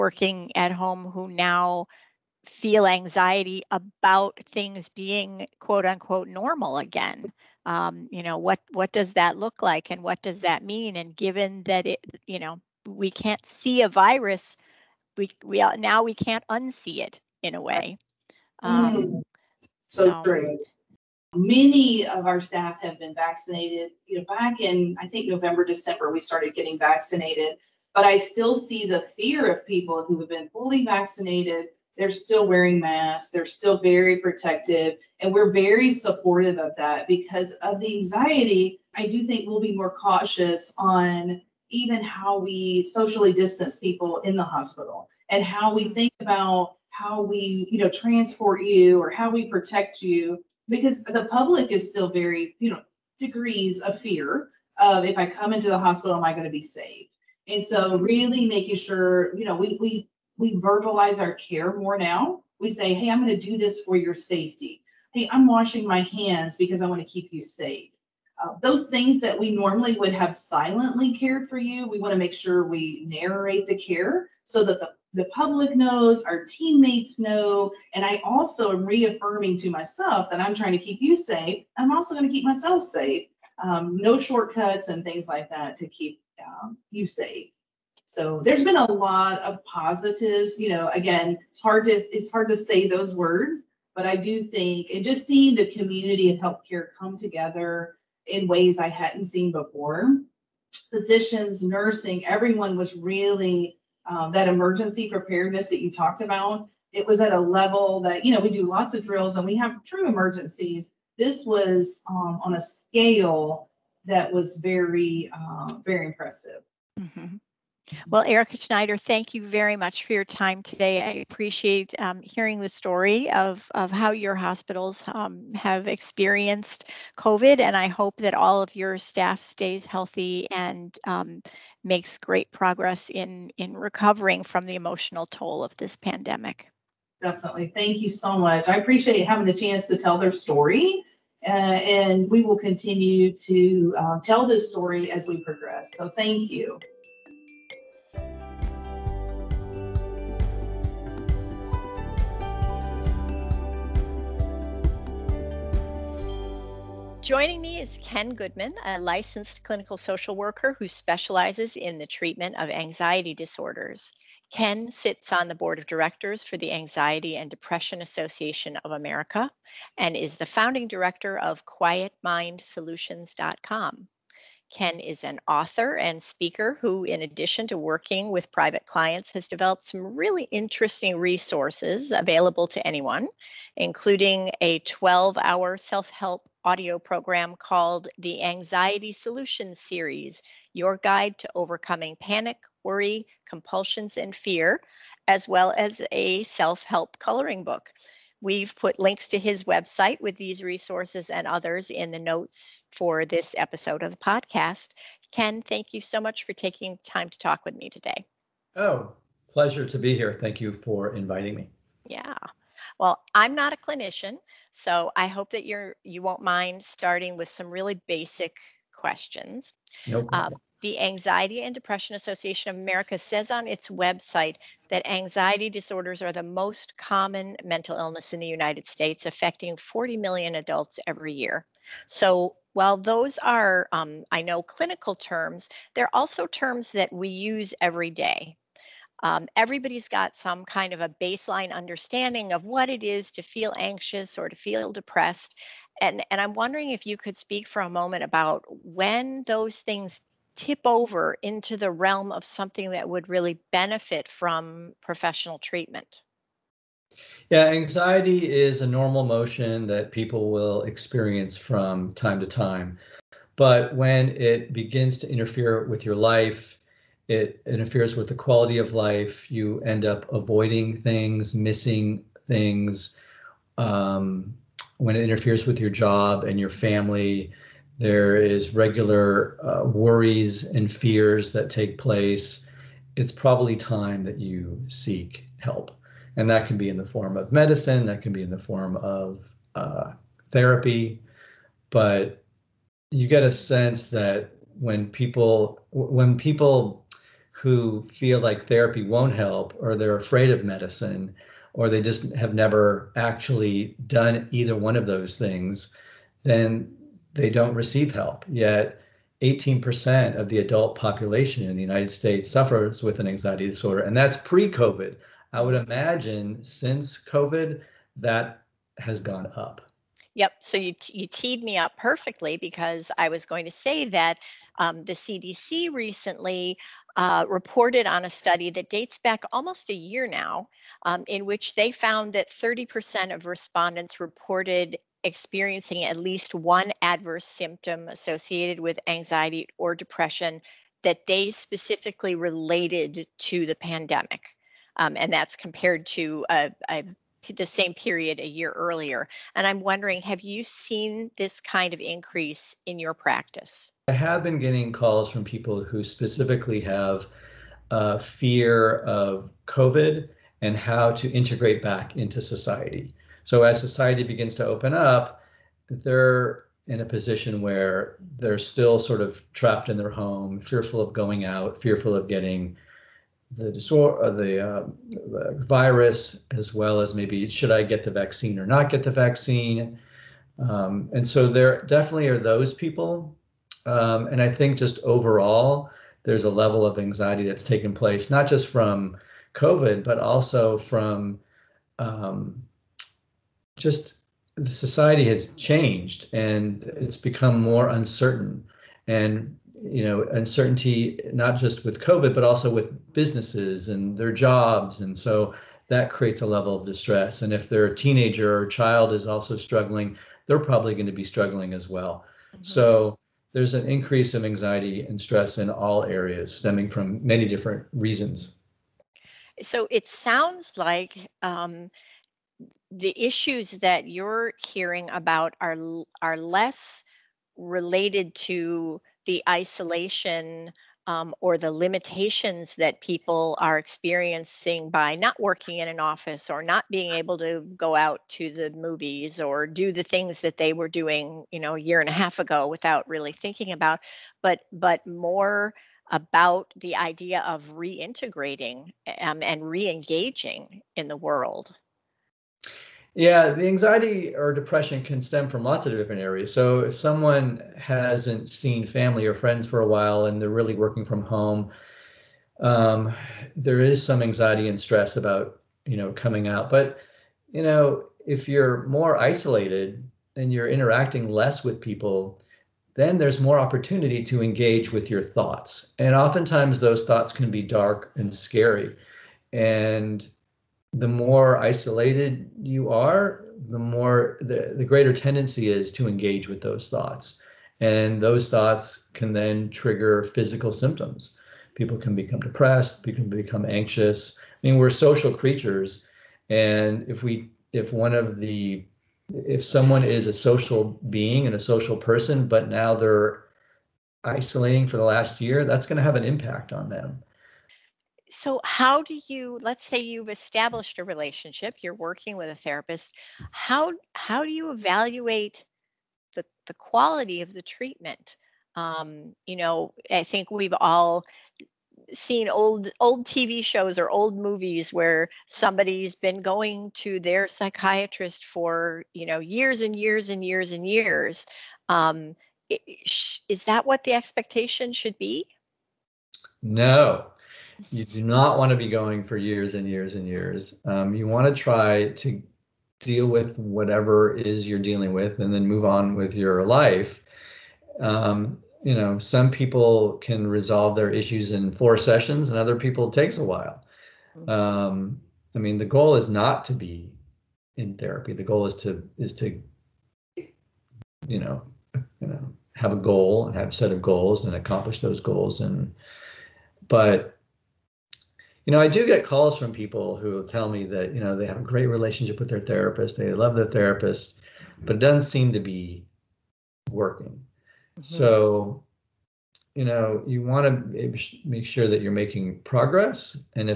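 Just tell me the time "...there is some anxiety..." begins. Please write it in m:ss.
7:43.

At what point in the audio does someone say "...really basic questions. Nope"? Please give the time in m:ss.
3:37.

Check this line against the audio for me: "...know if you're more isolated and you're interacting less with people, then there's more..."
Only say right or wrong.
right.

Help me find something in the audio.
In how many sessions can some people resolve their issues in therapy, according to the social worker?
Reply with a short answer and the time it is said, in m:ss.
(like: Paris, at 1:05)
4, at 9:11.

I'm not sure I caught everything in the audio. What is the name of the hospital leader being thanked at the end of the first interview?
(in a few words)
Erica Schneider.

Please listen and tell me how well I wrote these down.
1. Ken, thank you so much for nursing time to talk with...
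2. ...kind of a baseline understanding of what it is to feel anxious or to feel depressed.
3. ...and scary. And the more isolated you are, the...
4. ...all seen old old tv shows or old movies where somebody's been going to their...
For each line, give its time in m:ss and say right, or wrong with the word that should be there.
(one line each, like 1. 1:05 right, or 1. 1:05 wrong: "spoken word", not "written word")
1. 3:25 wrong: "taking", not "nursing"
2. 4:00 right
3. 7:58 right
4. 8:40 right.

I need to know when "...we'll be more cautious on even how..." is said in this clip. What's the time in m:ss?
0:39.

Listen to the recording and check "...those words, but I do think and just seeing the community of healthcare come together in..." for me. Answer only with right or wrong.
right.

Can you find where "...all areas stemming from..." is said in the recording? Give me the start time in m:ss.
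6:55.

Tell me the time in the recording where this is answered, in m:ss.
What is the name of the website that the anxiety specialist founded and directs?
2:51.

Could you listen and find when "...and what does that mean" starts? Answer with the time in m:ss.
0:09.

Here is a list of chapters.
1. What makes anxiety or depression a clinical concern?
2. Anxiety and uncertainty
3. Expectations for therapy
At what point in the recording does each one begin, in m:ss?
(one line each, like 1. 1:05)
1. 3:45
2. 5:54
3. 8:39.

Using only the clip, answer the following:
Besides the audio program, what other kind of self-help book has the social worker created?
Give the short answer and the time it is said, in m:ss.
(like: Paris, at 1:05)
coloring book, at 3:17.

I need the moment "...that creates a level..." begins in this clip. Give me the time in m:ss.
6:45.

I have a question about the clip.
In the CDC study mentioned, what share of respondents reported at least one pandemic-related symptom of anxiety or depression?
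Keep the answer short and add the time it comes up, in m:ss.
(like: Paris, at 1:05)
30%, at 5:32.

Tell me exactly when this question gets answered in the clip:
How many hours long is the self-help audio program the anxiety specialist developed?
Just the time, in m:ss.
3:04.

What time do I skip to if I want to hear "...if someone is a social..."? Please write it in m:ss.
8:19.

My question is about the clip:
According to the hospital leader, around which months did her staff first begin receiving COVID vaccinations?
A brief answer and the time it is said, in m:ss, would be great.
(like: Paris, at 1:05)
November, December, at 0:25.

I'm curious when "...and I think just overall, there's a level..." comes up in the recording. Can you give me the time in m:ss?
6:24.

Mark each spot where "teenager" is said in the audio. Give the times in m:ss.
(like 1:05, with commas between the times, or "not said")
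6:47.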